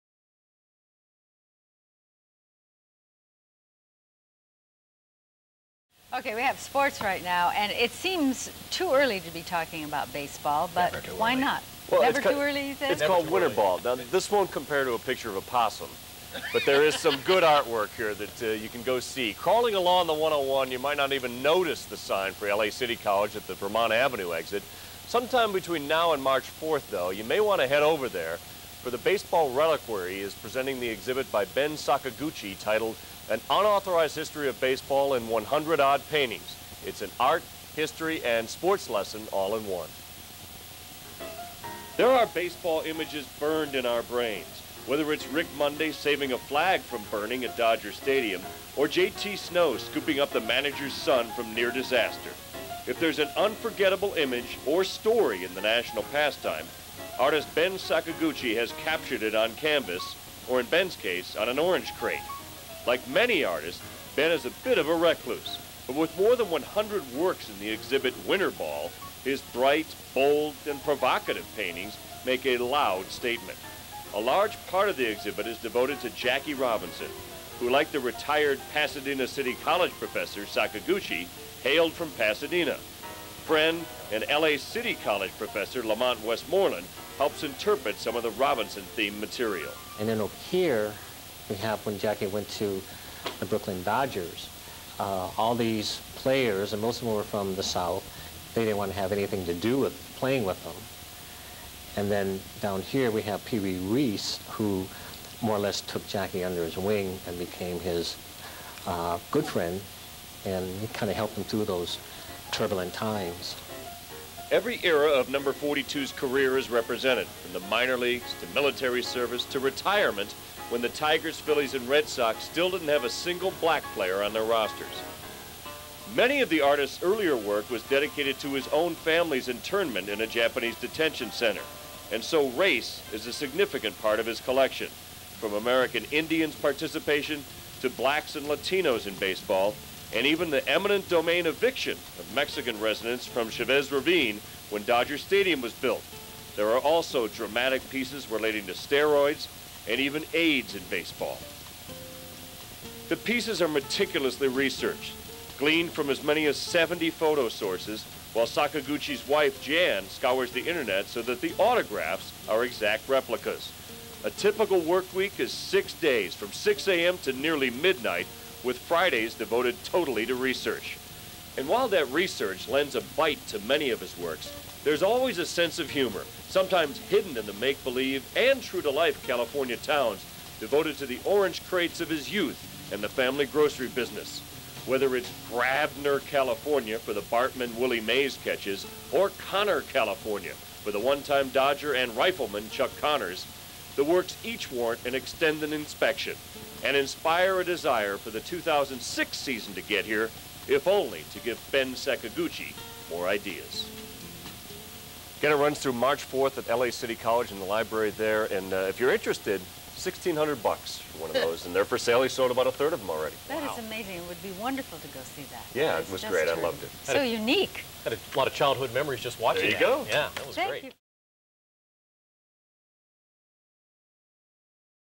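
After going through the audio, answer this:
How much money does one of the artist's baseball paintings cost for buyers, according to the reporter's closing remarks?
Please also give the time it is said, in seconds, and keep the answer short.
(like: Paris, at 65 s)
$1,600, at 209 s.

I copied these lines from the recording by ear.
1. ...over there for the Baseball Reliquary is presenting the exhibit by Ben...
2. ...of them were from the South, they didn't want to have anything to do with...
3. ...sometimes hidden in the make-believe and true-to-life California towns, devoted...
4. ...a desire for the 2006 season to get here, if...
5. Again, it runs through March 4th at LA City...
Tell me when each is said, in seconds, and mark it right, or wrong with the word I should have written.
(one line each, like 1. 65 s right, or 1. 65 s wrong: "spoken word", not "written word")
1. 27 s right
2. 96 s right
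3. 176 s right
4. 197 s right
5. 205 s right.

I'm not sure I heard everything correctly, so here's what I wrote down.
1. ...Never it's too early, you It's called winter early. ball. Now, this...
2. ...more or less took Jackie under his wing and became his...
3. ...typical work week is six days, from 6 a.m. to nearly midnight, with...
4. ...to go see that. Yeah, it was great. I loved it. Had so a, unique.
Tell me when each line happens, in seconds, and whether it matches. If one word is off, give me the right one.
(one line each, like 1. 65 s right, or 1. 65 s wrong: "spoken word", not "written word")
1. 12 s right
2. 105 s right
3. 164 s right
4. 214 s right.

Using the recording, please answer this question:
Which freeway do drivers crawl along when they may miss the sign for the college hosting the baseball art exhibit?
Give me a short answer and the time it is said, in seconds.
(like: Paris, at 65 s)
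101, at 20 s.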